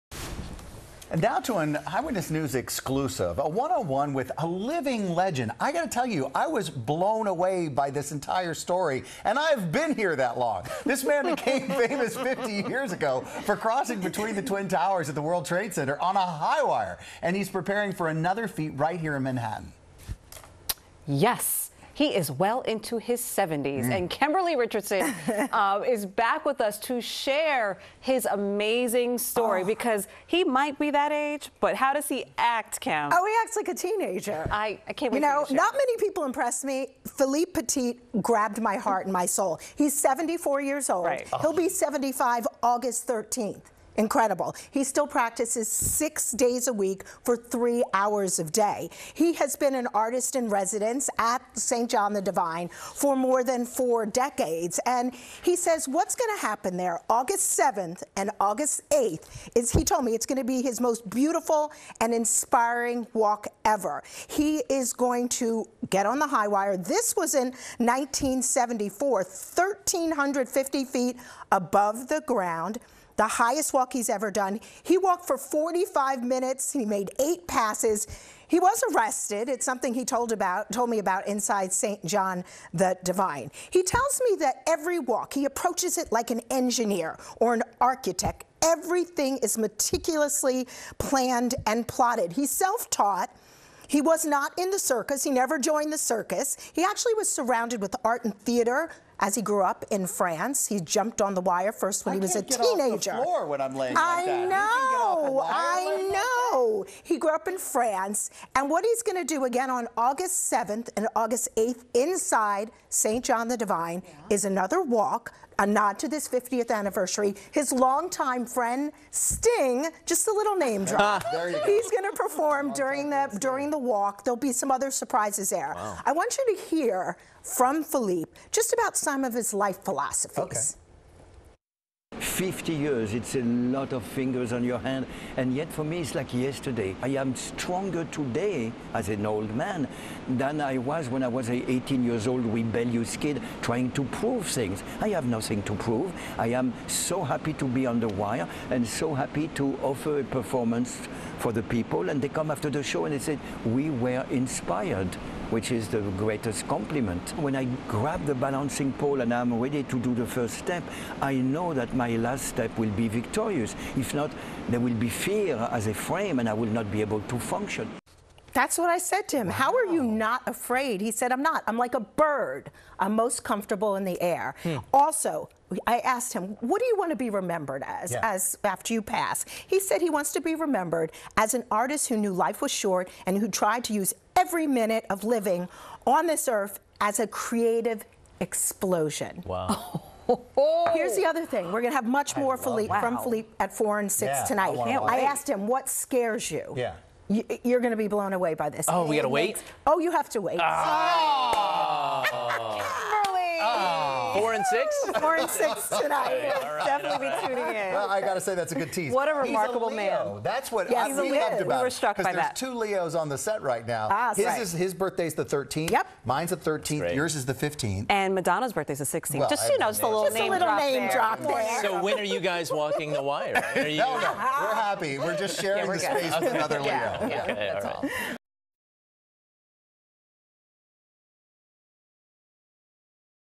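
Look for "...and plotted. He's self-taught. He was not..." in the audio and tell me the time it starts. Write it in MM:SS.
01:31.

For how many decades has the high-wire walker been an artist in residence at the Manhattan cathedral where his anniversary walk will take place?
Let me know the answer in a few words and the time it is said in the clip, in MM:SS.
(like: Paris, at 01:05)
More than 4 decades, at 00:53.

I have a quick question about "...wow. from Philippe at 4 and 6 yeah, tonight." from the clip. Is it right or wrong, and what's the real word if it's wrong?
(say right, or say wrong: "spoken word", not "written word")
right.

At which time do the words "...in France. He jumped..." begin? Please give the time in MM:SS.
01:39.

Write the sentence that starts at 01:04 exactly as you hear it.
He is going to get on the high wire.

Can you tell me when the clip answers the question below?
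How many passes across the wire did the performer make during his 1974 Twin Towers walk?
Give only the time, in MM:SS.
01:17.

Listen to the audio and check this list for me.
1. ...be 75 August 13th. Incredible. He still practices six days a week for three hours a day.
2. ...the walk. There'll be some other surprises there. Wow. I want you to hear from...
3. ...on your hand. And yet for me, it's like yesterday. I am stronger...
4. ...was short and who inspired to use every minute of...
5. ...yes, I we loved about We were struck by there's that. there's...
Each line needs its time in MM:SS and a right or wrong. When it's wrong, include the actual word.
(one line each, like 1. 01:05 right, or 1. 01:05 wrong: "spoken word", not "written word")
1. 00:41 right
2. 02:03 right
3. 02:14 right
4. 03:02 wrong: "tried", not "inspired"
5. 03:30 right.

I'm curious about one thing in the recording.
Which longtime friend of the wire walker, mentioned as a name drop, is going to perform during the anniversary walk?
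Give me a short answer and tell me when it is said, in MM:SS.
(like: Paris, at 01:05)
Sting, at 01:59.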